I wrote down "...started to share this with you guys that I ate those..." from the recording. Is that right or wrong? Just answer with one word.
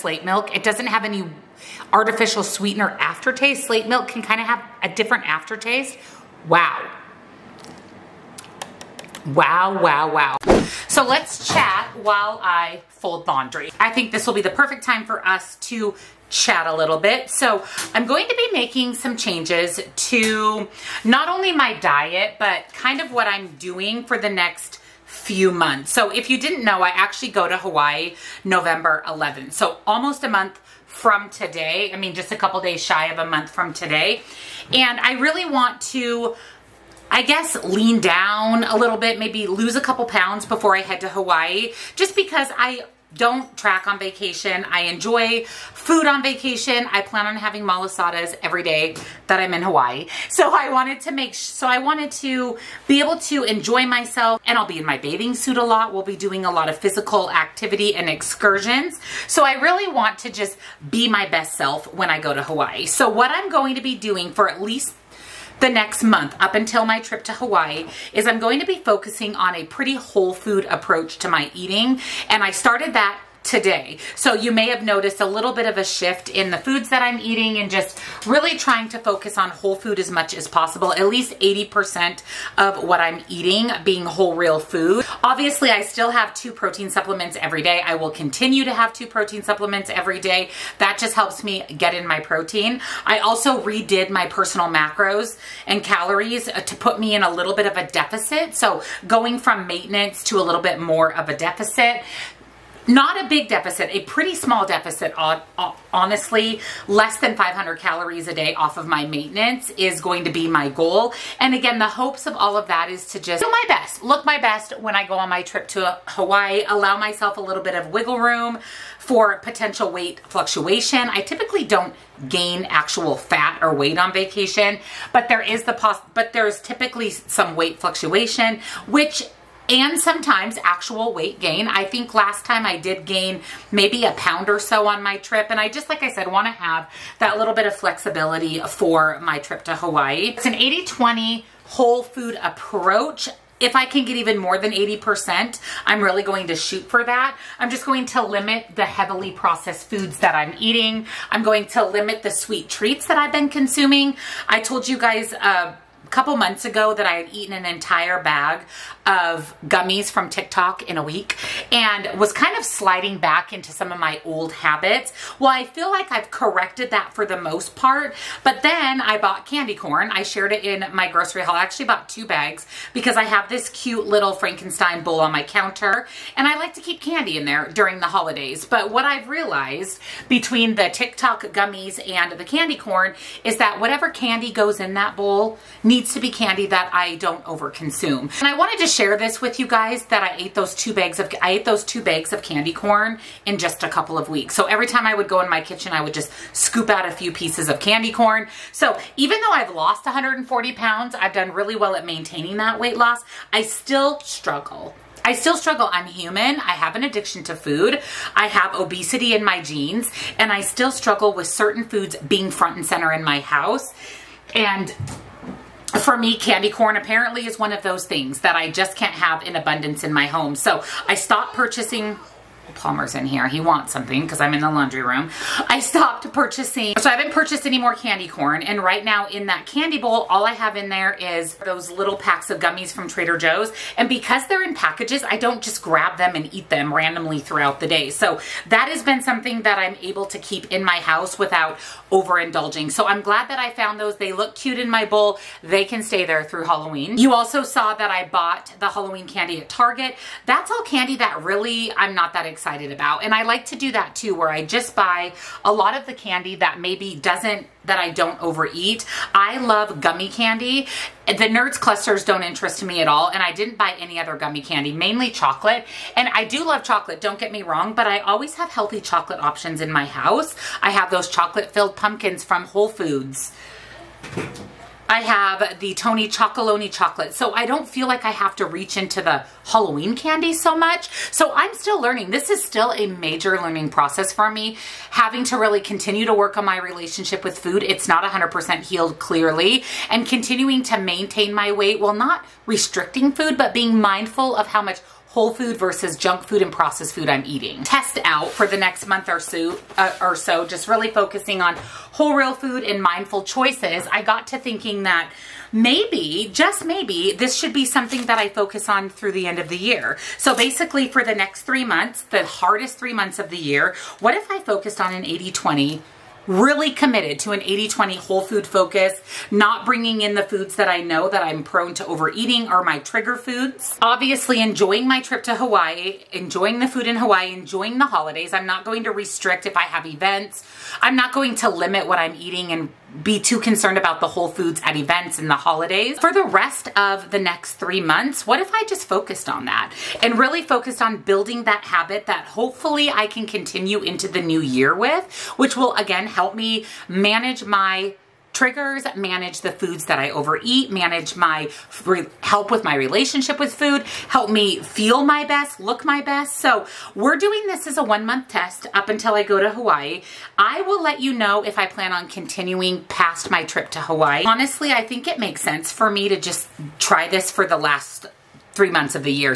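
wrong.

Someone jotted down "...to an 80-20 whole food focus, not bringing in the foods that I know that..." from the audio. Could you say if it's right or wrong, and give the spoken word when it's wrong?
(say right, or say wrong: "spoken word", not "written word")
right.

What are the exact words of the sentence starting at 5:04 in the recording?
I got to thinking that maybe, just maybe, this should be something that I focus on through the end of the year.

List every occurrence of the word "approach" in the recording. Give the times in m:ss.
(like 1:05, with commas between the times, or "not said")
1:10, 2:22.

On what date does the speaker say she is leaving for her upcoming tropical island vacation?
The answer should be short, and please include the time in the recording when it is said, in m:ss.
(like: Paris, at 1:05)
November 11, at 0:28.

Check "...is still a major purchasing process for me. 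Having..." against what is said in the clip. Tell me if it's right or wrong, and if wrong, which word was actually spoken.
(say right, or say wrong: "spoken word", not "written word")
wrong: "learning", not "purchasing".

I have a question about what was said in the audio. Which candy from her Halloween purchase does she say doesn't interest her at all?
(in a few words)
Nerds Clusters.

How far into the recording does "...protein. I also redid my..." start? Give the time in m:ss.
1:32.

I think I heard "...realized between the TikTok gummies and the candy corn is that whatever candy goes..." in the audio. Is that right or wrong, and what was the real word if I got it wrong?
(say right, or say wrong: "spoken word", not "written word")
right.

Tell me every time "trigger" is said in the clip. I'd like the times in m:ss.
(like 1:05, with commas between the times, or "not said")
5:22, 5:48.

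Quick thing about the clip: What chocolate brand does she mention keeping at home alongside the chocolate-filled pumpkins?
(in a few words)
Tony's Chocolonely.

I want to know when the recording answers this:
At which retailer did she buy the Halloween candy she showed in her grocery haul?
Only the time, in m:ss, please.
4:09.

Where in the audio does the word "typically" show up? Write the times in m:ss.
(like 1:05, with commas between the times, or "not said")
2:01, 2:06.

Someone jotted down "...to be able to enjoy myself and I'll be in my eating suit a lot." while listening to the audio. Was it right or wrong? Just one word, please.
wrong.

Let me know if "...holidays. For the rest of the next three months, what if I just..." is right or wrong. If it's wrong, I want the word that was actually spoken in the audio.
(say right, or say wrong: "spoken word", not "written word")
right.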